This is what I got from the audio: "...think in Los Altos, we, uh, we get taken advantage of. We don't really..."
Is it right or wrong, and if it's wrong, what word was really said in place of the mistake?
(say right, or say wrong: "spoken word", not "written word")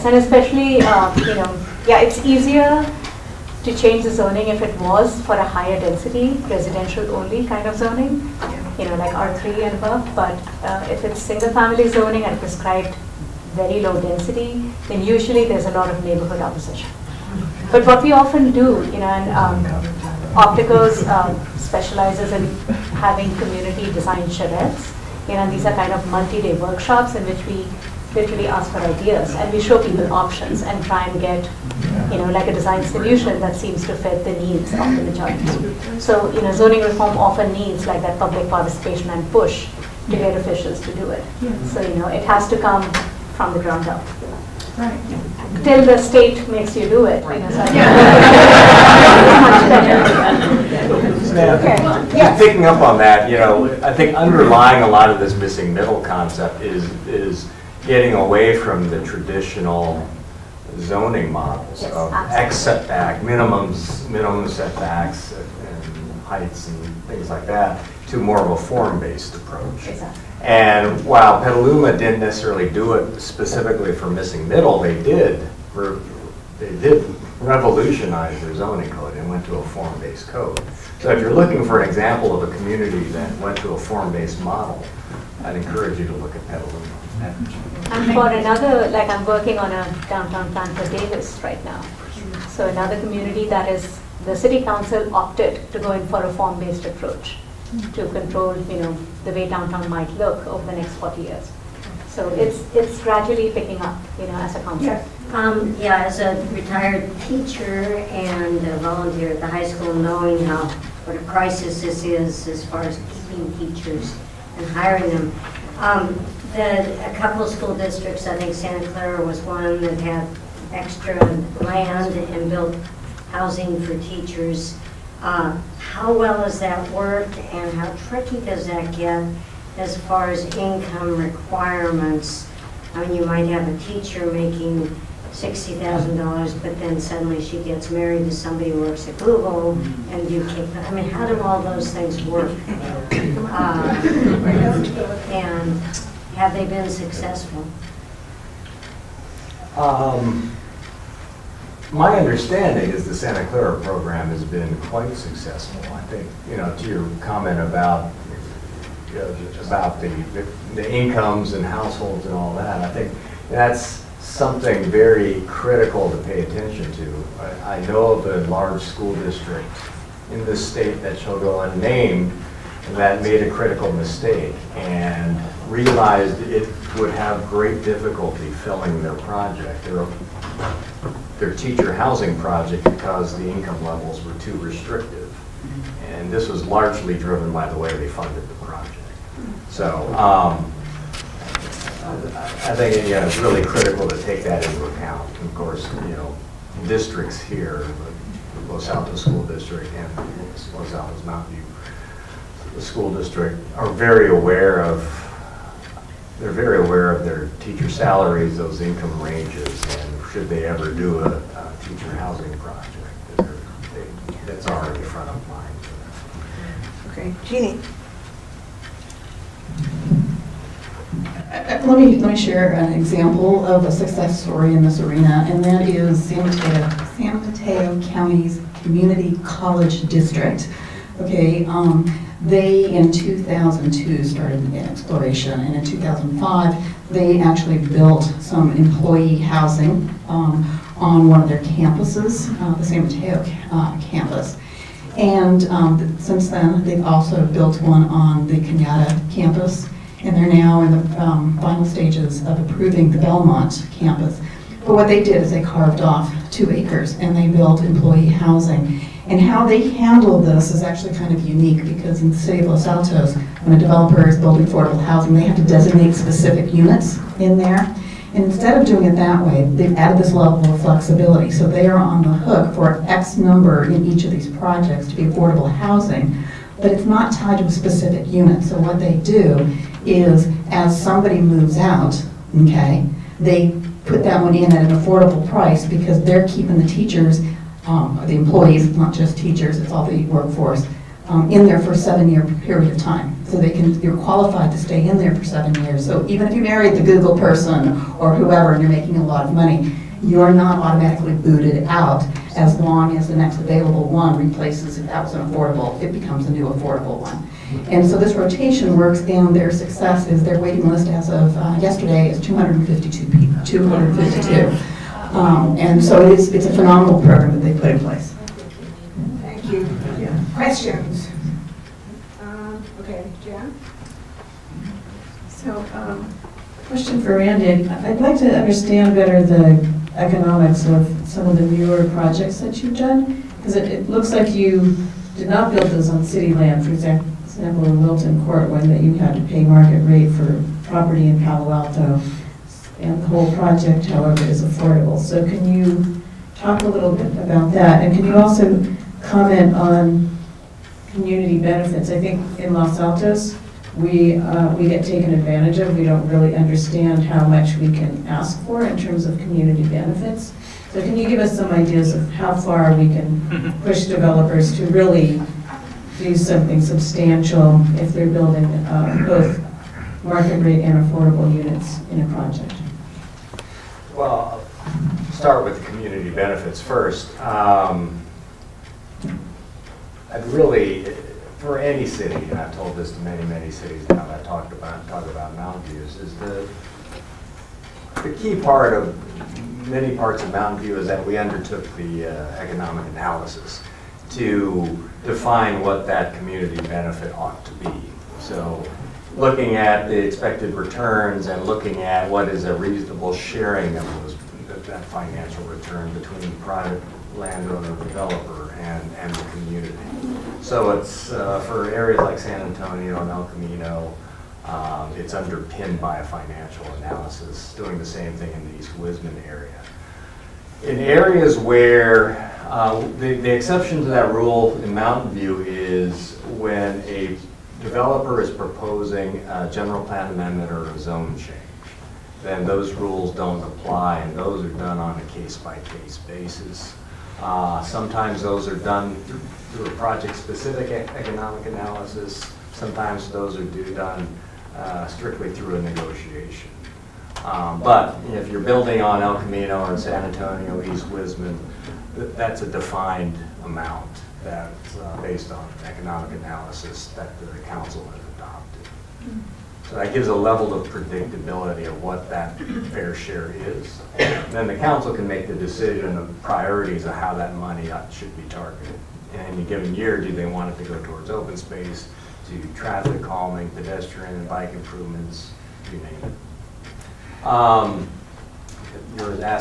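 right.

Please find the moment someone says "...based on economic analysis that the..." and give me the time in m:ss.
7:35.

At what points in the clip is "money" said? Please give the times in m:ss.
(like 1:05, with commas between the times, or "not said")
4:59, 7:47.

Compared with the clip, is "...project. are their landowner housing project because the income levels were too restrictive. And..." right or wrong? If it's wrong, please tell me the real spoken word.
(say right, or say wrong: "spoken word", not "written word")
wrong: "teacher", not "landowner".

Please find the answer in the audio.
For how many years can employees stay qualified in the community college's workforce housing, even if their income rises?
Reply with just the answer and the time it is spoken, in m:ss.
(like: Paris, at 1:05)
7, at 4:51.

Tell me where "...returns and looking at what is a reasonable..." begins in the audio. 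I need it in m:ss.
6:40.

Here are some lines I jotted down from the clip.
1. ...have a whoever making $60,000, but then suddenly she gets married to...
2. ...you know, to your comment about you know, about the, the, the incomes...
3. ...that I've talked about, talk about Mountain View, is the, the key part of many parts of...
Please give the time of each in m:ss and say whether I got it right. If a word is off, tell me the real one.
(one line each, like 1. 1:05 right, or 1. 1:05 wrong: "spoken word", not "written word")
1. 2:13 wrong: "teacher", not "whoever"
2. 2:36 right
3. 6:24 right.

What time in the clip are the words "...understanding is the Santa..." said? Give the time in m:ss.
2:32.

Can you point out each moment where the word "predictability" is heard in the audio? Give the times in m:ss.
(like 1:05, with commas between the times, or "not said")
7:40.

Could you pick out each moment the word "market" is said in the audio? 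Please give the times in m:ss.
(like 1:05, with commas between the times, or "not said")
5:39, 6:10.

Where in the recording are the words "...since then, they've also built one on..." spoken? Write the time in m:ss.
4:06.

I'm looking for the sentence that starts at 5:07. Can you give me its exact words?
And so this rotation works down their success is their waiting list as of uh, yesterday is 252 people, 252.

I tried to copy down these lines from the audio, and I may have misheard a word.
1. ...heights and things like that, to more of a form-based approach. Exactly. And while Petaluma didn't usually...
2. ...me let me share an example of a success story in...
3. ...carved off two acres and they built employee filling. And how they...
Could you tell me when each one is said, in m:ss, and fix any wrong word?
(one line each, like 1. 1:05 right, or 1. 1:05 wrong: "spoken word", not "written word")
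1. 1:06 wrong: "necessarily", not "usually"
2. 3:41 right
3. 4:15 wrong: "housing", not "filling".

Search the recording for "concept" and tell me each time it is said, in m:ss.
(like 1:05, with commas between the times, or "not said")
0:56, 1:44.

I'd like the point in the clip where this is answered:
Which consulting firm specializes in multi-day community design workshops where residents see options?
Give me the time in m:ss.
0:20.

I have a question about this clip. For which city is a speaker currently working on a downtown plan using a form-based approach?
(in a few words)
Davis.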